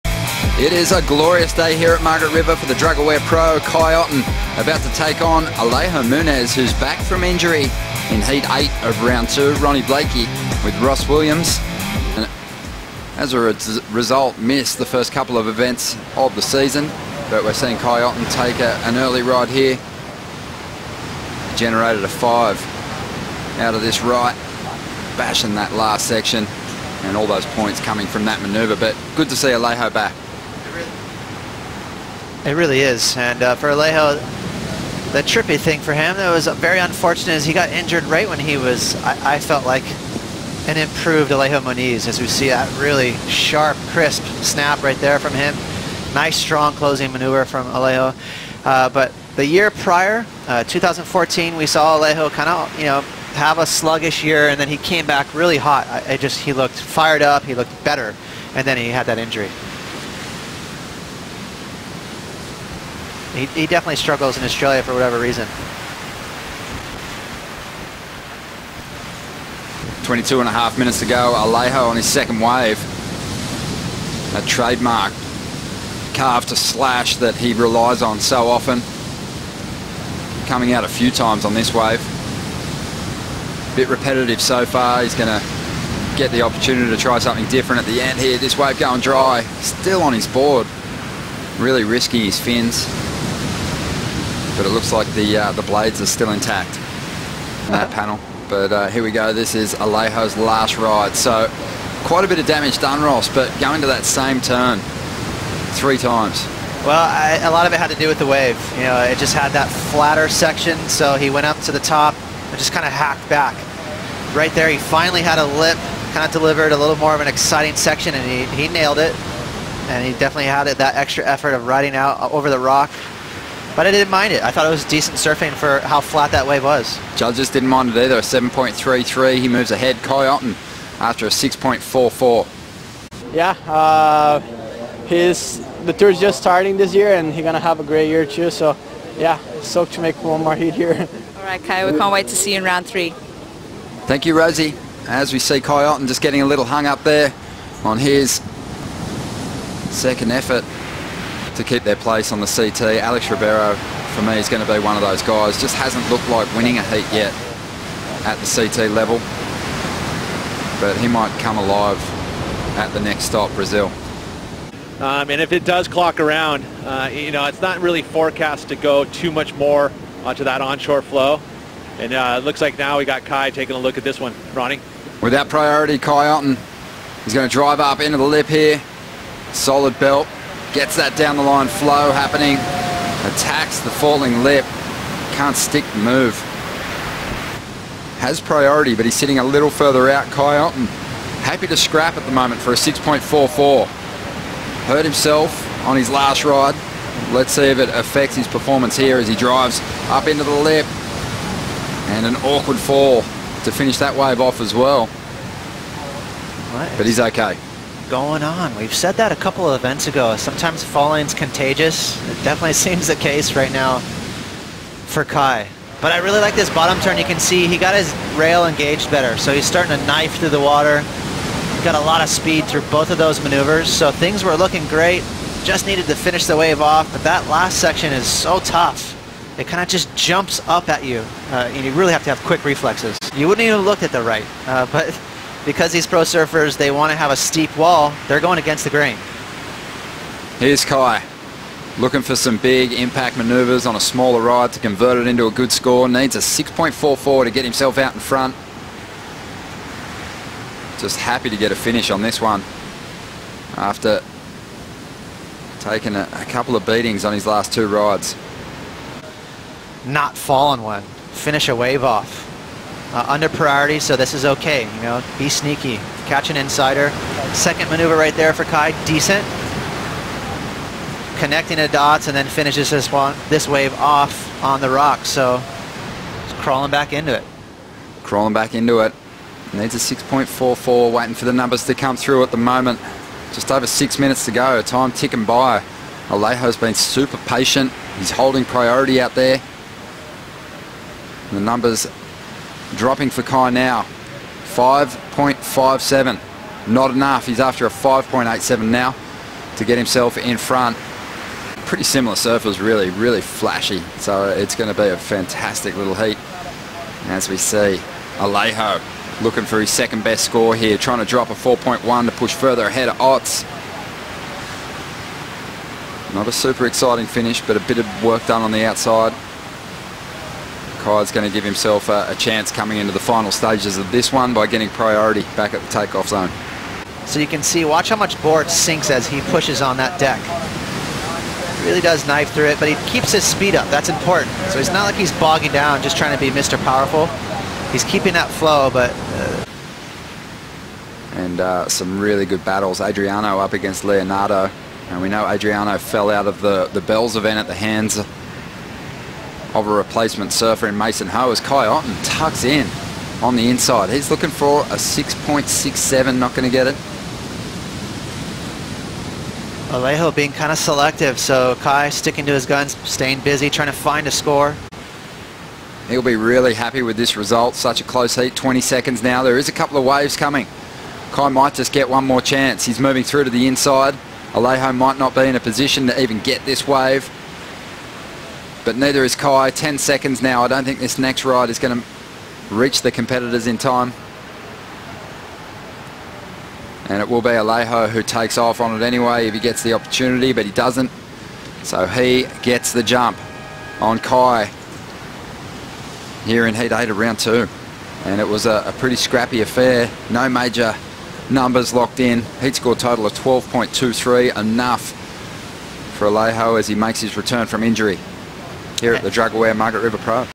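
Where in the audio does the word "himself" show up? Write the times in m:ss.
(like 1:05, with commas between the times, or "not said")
3:15, 4:07, 4:59, 5:21.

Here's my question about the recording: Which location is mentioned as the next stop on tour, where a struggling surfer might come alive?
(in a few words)
Brazil.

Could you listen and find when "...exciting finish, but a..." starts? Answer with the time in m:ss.
5:16.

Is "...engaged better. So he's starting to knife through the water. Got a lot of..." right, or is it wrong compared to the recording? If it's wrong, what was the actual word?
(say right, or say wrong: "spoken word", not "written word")
right.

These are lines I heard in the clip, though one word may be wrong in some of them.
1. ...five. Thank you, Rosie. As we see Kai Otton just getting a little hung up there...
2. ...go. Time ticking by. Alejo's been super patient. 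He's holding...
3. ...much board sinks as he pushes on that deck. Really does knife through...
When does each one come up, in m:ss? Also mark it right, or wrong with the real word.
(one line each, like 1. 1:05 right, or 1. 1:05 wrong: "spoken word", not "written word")
1. 2:22 wrong: "three", not "five"
2. 4:44 right
3. 5:28 right.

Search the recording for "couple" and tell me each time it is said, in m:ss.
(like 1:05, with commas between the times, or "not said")
0:15, 3:29, 4:16, 6:09.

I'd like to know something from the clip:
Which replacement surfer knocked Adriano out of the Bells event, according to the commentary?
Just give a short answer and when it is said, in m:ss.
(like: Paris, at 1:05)
Mason Ho, at 5:50.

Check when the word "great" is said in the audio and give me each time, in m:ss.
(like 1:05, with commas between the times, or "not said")
2:17, 3:44.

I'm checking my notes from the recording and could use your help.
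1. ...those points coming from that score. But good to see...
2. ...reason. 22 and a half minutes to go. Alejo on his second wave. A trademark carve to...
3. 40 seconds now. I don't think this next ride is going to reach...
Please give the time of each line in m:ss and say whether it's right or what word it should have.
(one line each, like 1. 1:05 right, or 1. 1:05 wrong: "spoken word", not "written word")
1. 0:27 wrong: "manoeuvre", not "score"
2. 1:05 right
3. 6:19 wrong: "10", not "40".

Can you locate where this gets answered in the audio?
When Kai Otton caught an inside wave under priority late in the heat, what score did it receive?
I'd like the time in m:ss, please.
4:54.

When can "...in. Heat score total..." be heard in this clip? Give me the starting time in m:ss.
6:42.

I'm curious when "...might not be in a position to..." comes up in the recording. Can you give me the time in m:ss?
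6:14.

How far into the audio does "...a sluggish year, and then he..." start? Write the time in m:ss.
0:53.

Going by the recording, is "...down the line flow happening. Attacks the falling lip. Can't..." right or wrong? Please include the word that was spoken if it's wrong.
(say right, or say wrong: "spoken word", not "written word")
right.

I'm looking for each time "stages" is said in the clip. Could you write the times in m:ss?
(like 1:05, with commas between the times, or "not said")
5:23.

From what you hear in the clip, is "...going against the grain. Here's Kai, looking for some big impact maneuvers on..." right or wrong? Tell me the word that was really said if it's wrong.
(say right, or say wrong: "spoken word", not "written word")
right.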